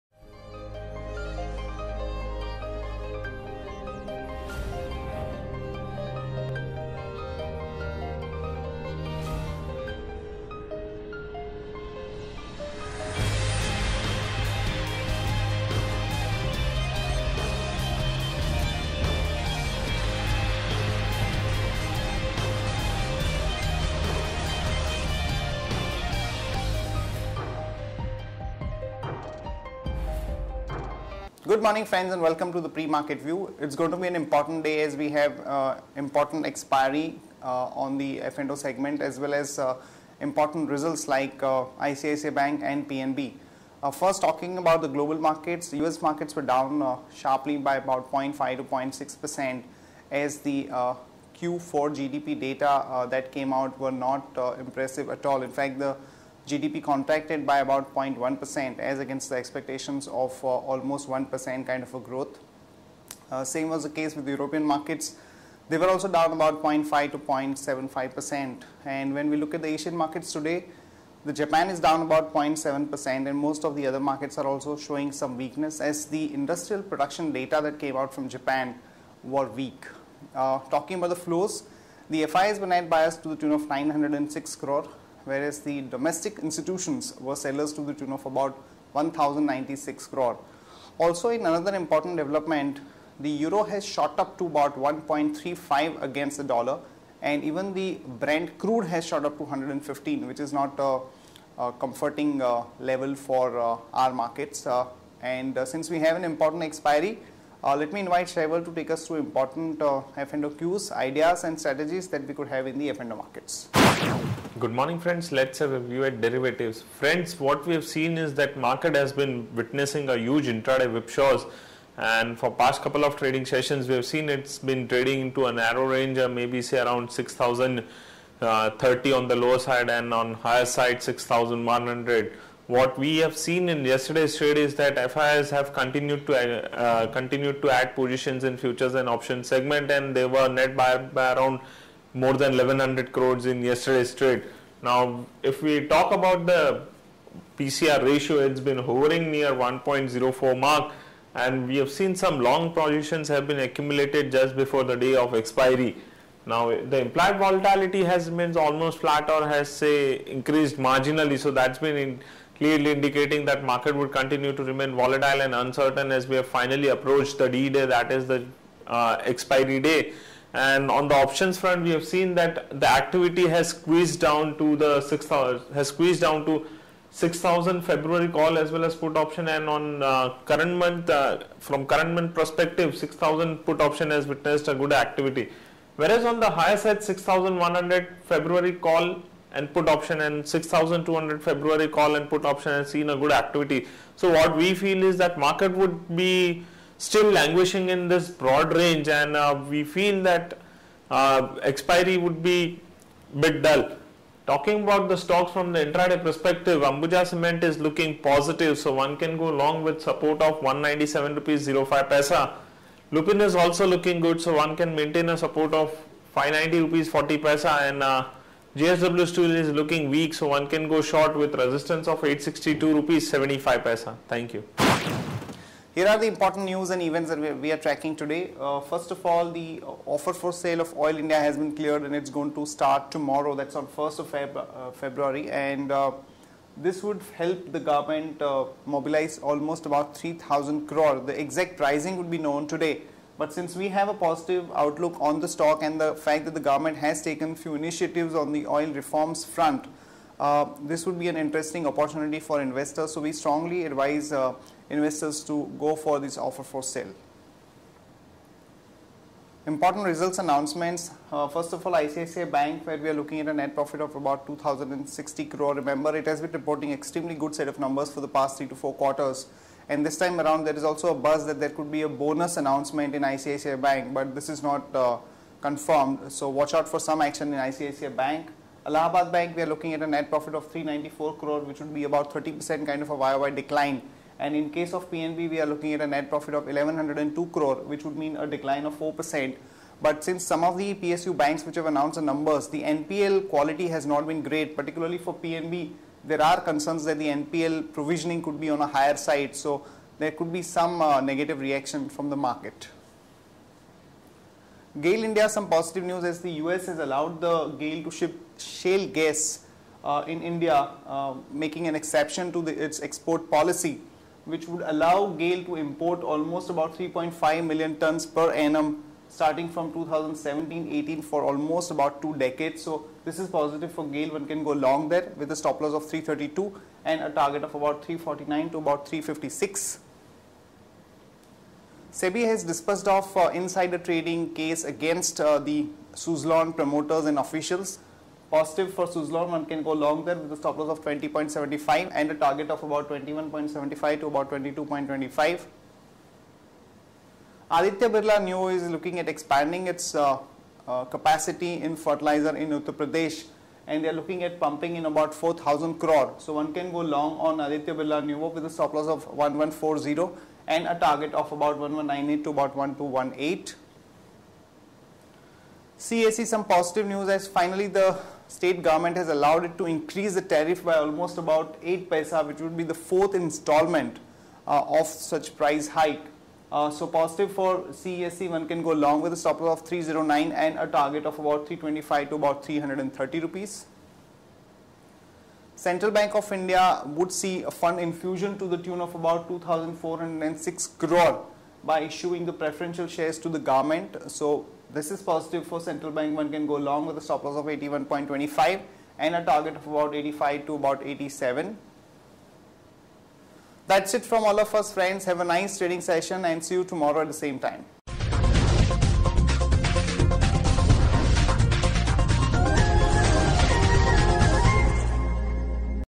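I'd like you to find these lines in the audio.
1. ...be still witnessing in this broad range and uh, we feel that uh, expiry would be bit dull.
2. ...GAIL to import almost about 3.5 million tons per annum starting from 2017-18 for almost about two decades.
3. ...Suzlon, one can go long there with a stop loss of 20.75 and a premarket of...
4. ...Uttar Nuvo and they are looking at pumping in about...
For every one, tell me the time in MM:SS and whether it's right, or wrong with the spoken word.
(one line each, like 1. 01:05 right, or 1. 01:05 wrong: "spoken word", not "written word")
1. 03:16 wrong: "languishing", not "witnessing"
2. 05:15 right
3. 05:39 wrong: "target", not "premarket"
4. 05:52 wrong: "Pradesh", not "Nuvo".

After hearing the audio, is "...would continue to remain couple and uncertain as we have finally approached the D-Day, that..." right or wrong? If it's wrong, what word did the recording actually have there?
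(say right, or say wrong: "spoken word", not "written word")
wrong: "volatile", not "couple".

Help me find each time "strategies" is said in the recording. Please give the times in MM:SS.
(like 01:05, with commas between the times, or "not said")
01:51.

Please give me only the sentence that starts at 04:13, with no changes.
So we strongly advise uh, investors to go for this offer for sale.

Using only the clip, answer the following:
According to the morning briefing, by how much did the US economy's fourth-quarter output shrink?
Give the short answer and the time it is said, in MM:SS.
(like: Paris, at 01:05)
0.1%, at 00:57.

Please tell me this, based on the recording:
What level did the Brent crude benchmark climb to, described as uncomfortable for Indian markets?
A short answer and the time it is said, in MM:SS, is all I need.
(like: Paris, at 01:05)
115, at 01:39.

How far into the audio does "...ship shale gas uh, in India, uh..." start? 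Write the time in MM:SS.
05:08.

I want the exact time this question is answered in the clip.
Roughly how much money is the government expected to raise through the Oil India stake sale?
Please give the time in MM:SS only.
04:00.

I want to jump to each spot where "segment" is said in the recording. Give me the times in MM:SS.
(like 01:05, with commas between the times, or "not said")
00:38, 02:19.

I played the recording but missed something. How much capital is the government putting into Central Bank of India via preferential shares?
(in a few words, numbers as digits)
2,406 crore.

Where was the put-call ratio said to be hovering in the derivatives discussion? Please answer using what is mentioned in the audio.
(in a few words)
1.04.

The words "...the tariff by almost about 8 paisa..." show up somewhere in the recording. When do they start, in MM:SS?
06:10.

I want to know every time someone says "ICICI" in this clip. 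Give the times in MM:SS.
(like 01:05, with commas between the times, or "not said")
00:41, 04:21, 04:33, 04:37.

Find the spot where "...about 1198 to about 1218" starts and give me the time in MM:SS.
06:01.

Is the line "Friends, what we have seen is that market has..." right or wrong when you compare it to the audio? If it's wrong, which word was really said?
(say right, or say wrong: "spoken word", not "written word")
right.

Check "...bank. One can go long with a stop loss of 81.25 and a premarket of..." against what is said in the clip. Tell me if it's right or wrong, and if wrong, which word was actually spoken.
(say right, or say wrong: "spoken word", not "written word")
wrong: "target", not "premarket".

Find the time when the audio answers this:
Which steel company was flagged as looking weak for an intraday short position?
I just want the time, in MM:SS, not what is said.
03:38.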